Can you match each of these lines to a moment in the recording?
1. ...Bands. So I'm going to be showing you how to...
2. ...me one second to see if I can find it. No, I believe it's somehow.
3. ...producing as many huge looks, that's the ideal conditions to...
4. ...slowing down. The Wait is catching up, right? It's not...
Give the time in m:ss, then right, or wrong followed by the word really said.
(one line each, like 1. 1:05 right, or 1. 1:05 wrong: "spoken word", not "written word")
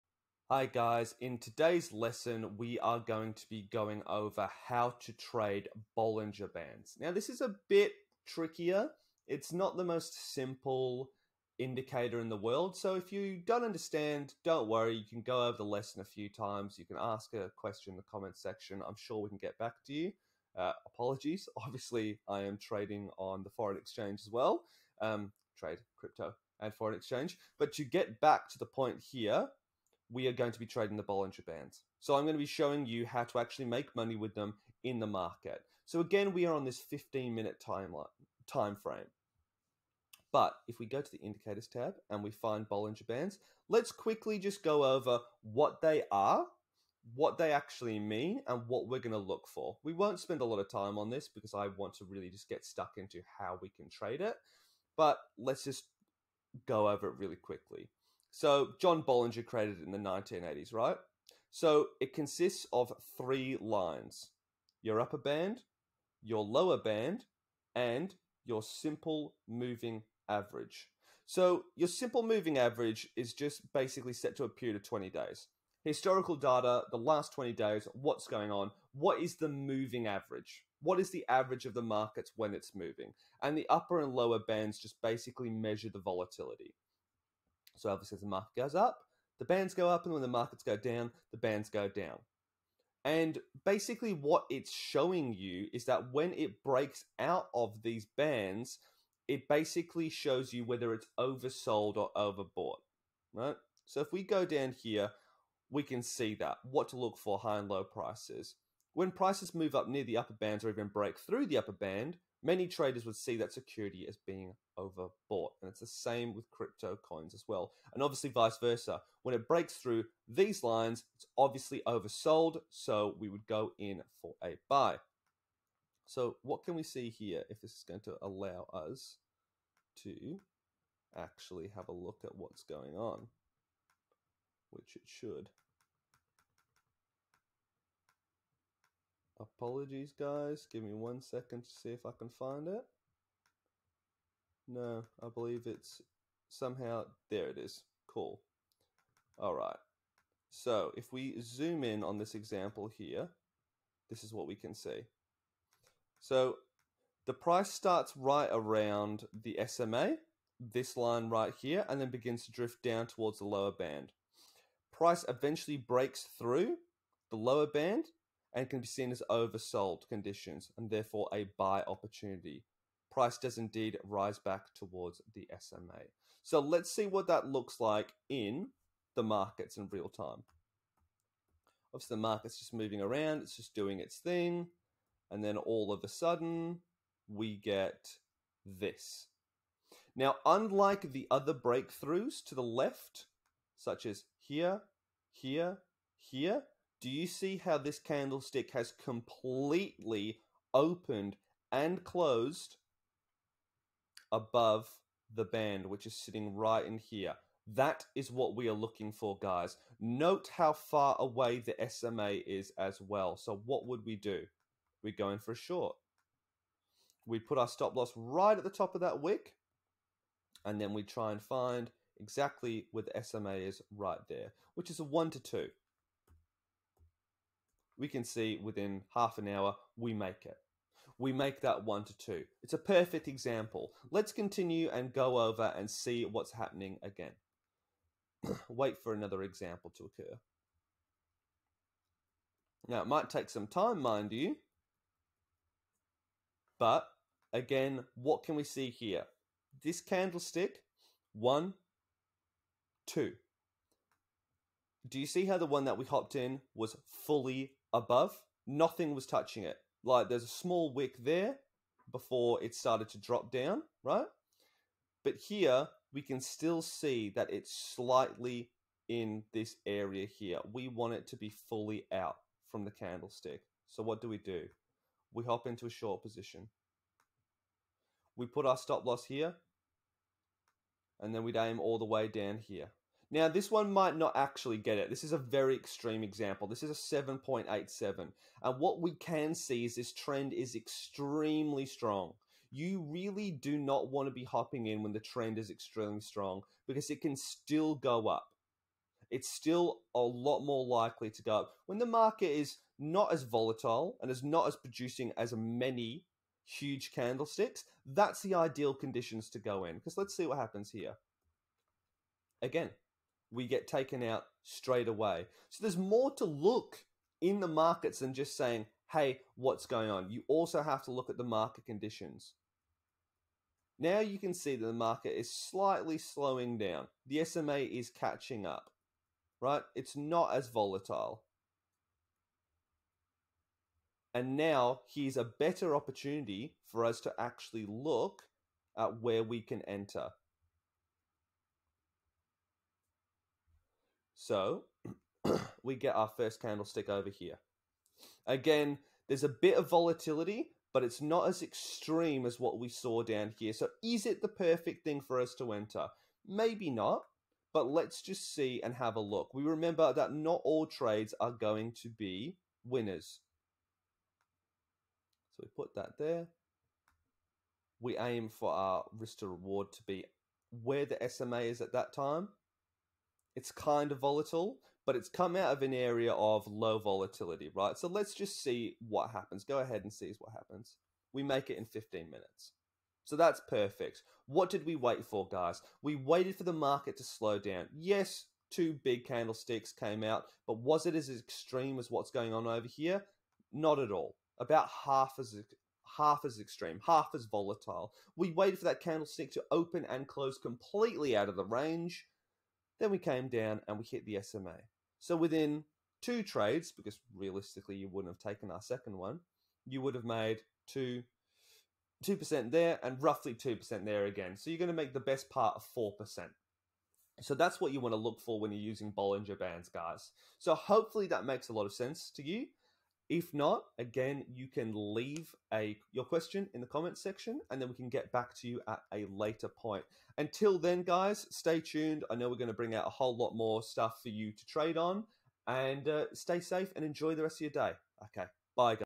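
1. 0:31 right
2. 2:20 right
3. 5:04 wrong: "candlesticks", not "looks"
4. 5:26 wrong: "SMA", not "Wait".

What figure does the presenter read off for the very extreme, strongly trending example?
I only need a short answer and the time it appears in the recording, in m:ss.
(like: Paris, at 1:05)
7.87, at 4:47.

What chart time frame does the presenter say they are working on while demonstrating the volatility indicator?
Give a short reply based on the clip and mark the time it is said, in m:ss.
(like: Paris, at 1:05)
15 minute, at 0:36.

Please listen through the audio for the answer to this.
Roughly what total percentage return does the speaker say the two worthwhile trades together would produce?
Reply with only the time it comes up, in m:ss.
6:55.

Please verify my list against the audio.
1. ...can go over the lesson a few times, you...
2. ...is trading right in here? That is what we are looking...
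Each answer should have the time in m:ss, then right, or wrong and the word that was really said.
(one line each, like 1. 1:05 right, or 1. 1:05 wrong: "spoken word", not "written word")
1. 0:15 right
2. 3:26 wrong: "sitting", not "trading".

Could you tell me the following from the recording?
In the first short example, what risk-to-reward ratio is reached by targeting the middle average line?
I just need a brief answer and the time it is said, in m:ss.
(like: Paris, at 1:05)
1 to 2, at 3:45.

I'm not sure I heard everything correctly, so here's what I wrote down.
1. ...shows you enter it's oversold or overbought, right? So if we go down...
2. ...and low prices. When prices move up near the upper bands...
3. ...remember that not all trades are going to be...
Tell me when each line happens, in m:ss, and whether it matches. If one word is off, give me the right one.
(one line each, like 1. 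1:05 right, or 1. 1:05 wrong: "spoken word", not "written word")
1. 1:40 wrong: "whether", not "enter"
2. 1:47 right
3. 5:59 right.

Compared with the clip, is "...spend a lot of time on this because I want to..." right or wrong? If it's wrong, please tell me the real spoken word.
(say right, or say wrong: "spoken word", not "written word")
right.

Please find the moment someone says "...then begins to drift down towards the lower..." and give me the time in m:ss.
2:42.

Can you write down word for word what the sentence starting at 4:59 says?
It's still a lot more likely to go up.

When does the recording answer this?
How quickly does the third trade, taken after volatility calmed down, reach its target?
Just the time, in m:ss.
6:21.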